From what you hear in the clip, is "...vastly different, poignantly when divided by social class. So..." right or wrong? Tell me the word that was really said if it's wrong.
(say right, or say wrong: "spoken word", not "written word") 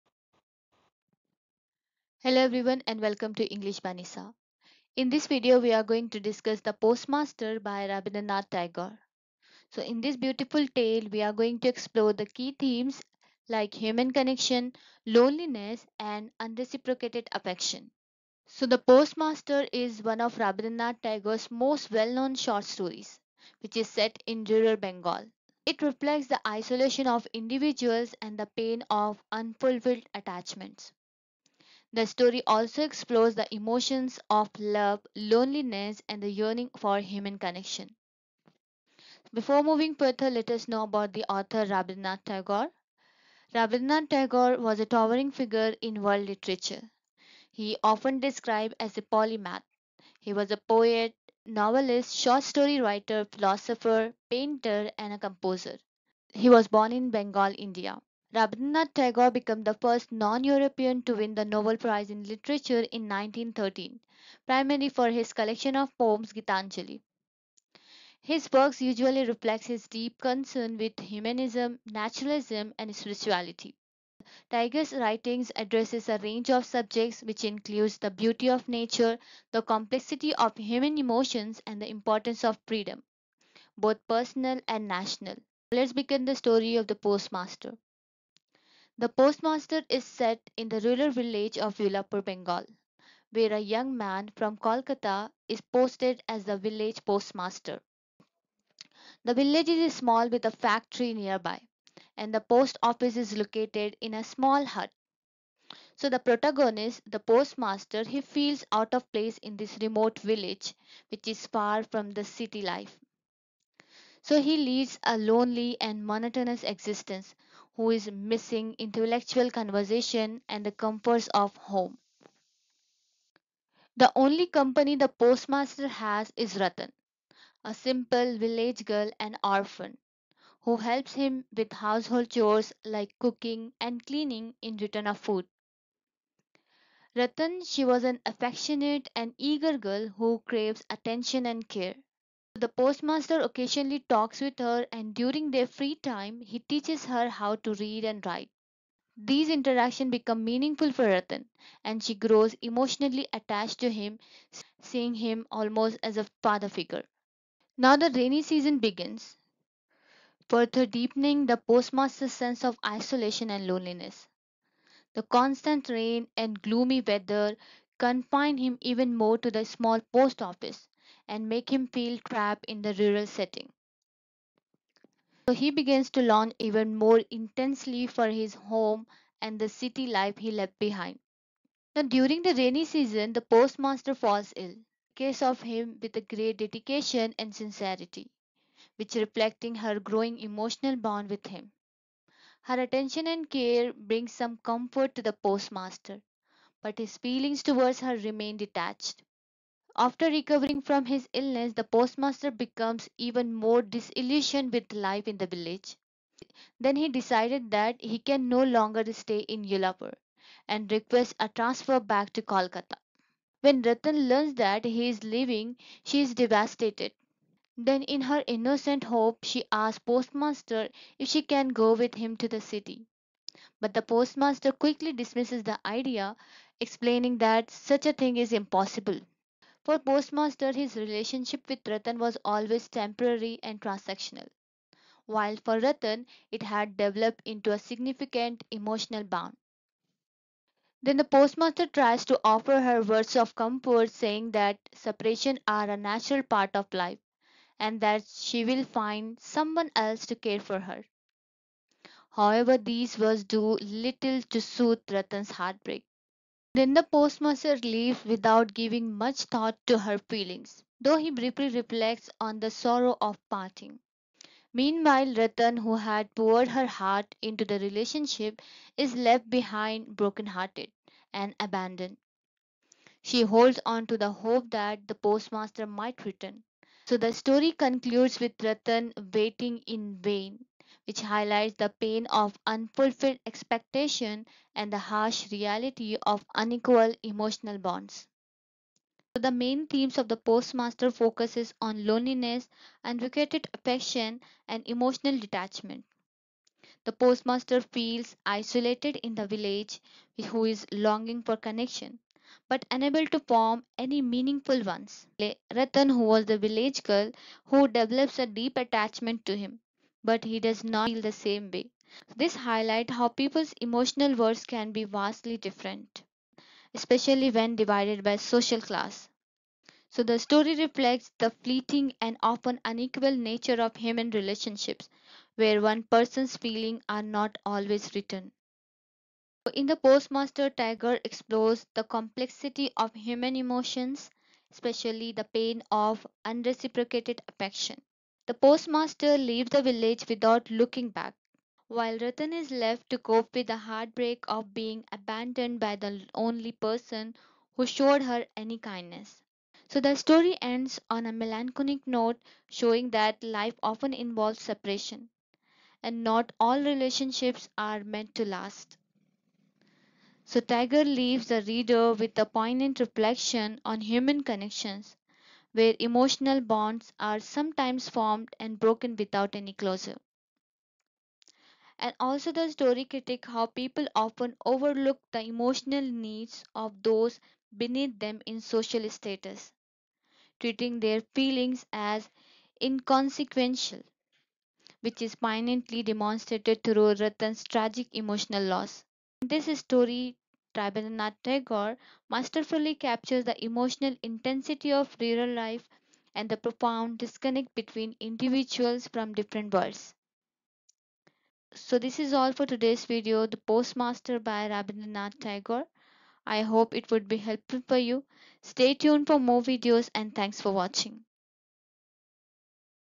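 wrong: "especially", not "poignantly".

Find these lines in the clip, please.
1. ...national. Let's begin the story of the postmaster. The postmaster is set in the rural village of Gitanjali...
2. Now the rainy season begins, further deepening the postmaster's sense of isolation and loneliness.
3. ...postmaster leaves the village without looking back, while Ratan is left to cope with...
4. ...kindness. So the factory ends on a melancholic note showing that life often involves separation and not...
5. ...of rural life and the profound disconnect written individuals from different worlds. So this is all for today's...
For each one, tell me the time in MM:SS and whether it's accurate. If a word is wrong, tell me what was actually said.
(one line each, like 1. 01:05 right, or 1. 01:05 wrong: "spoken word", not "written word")
1. 01:24 wrong: "Ulapur", not "Gitanjali"
2. 02:37 right
3. 05:38 right
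4. 05:48 wrong: "story", not "factory"
5. 06:34 wrong: "between", not "written".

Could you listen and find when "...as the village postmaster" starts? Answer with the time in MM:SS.
01:36.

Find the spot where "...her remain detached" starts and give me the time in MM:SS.
03:18.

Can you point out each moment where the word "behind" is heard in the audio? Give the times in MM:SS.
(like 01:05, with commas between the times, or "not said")
03:00, 04:29.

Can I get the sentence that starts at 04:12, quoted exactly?
However, these words do little to soothe Ratan's heartbreak.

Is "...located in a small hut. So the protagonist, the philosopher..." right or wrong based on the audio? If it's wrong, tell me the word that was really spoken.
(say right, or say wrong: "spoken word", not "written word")
wrong: "postmaster", not "philosopher".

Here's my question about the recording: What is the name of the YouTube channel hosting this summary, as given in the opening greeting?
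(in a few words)
English by Nisa.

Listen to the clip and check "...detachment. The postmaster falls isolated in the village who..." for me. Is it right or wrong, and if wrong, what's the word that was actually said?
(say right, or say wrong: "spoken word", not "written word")
wrong: "feels", not "falls".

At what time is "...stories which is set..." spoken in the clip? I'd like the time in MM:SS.
00:22.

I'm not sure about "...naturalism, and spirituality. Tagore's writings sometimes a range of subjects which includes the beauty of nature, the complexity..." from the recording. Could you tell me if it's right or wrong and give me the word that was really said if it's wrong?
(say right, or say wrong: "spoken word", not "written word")
wrong: "addresses", not "sometimes".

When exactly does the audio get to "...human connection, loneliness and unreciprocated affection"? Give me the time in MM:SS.
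00:13.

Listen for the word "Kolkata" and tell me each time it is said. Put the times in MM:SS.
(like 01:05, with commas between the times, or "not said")
01:34, 03:32.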